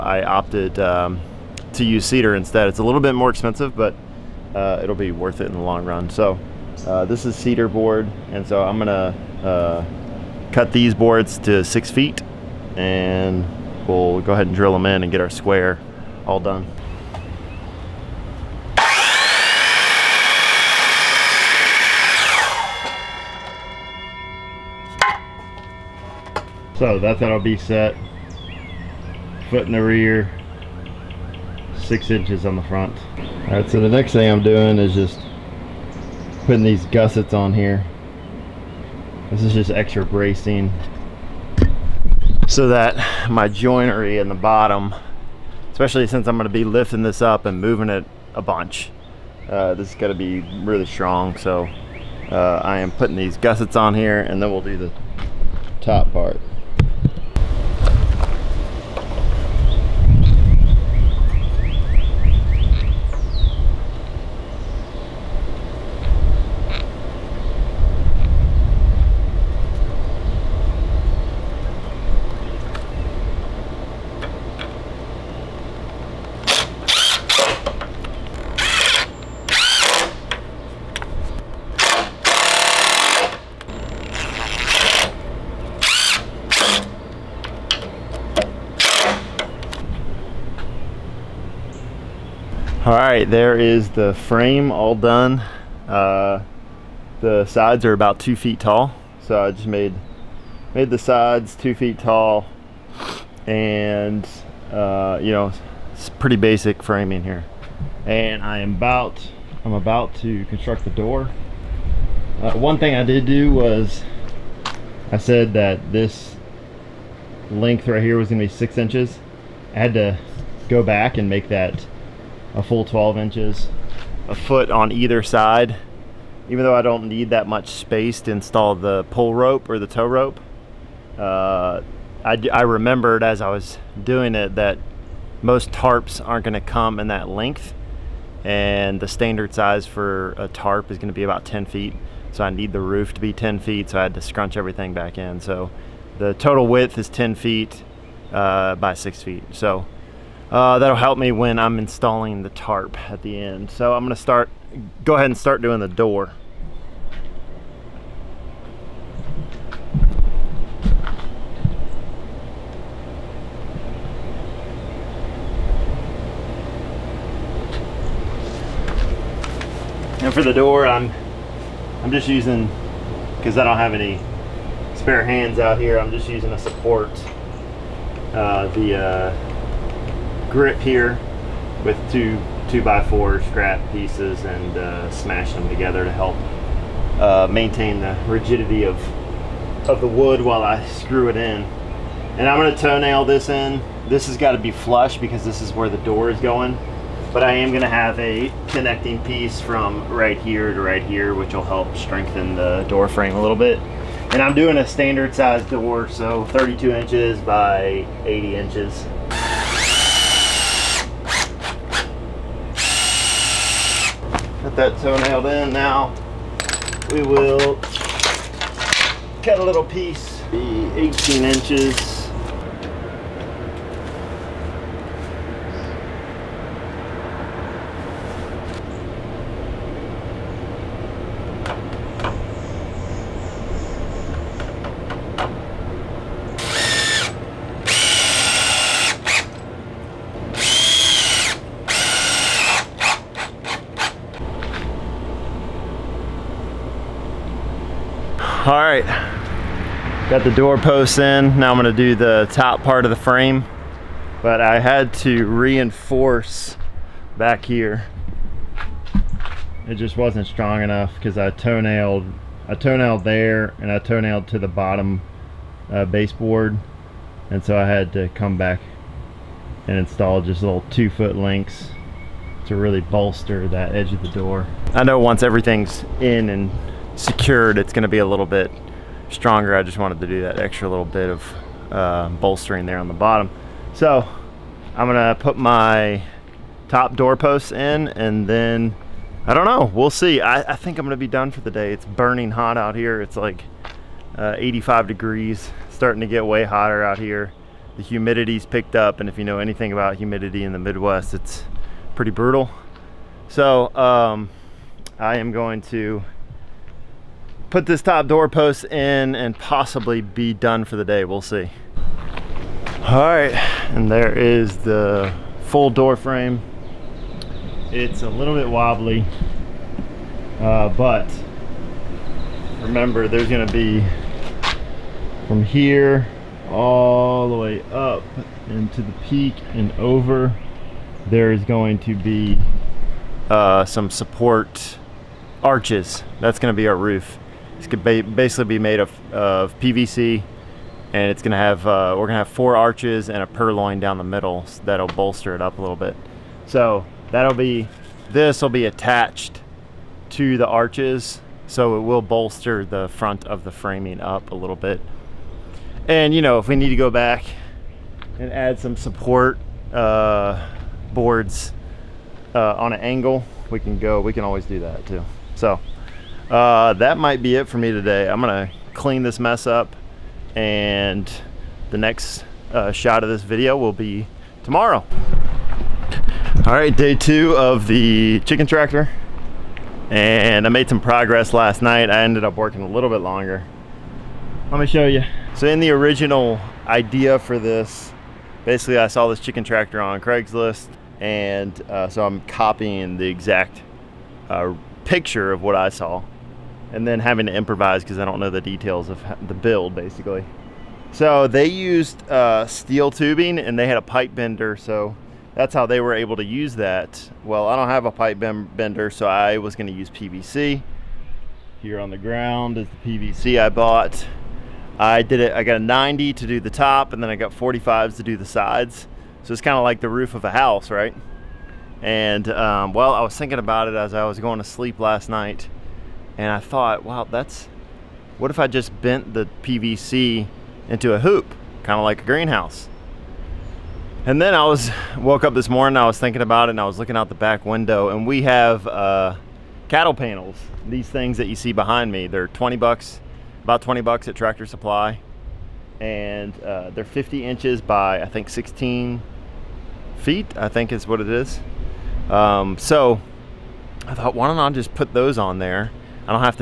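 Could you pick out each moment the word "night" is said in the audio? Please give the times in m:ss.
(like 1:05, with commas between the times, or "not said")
6:21, 7:05.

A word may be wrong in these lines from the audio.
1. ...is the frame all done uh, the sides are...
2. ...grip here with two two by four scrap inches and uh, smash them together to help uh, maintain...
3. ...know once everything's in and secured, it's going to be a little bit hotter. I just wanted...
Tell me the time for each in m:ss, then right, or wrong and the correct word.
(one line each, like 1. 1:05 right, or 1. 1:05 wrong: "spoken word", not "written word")
1. 1:33 right
2. 3:00 wrong: "pieces", not "inches"
3. 4:35 wrong: "stronger", not "hotter".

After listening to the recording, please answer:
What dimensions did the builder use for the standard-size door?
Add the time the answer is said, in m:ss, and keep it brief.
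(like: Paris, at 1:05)
32 by 80 inches, at 3:26.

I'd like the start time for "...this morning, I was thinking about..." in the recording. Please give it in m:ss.
7:15.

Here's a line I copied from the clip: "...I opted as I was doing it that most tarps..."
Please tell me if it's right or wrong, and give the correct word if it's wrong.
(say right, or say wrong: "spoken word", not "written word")
wrong: "remembered", not "opted".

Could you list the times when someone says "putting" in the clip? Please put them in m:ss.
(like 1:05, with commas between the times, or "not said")
0:36, 0:52.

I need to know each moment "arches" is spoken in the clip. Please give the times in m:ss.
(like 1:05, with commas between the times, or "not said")
5:35, 5:42, 5:50.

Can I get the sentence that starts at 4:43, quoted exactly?
So I'm going to put my top door posts in and then I don't know.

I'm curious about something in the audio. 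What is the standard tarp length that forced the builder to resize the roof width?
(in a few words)
10 feet.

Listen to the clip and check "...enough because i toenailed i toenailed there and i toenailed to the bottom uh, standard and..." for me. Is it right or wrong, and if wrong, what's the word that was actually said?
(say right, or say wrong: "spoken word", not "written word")
wrong: "baseboard", not "standard".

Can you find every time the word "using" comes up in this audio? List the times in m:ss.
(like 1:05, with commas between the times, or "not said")
2:52, 2:56.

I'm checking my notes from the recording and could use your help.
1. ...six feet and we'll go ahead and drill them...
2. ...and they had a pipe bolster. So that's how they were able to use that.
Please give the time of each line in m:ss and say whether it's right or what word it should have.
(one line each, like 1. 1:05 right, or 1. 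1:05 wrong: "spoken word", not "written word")
1. 0:11 right
2. 6:43 wrong: "bender", not "bolster".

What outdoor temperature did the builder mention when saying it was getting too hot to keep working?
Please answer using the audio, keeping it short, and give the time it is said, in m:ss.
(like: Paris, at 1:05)
85 degrees, at 4:54.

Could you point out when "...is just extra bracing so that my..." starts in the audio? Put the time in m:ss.
0:39.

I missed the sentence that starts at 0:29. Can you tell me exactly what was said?
Foot in the rear, six inches on the front.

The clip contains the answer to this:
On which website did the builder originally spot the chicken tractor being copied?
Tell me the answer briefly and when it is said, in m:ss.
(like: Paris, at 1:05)
Craigslist, at 6:30.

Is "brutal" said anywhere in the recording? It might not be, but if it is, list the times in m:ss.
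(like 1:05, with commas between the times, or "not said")
5:02.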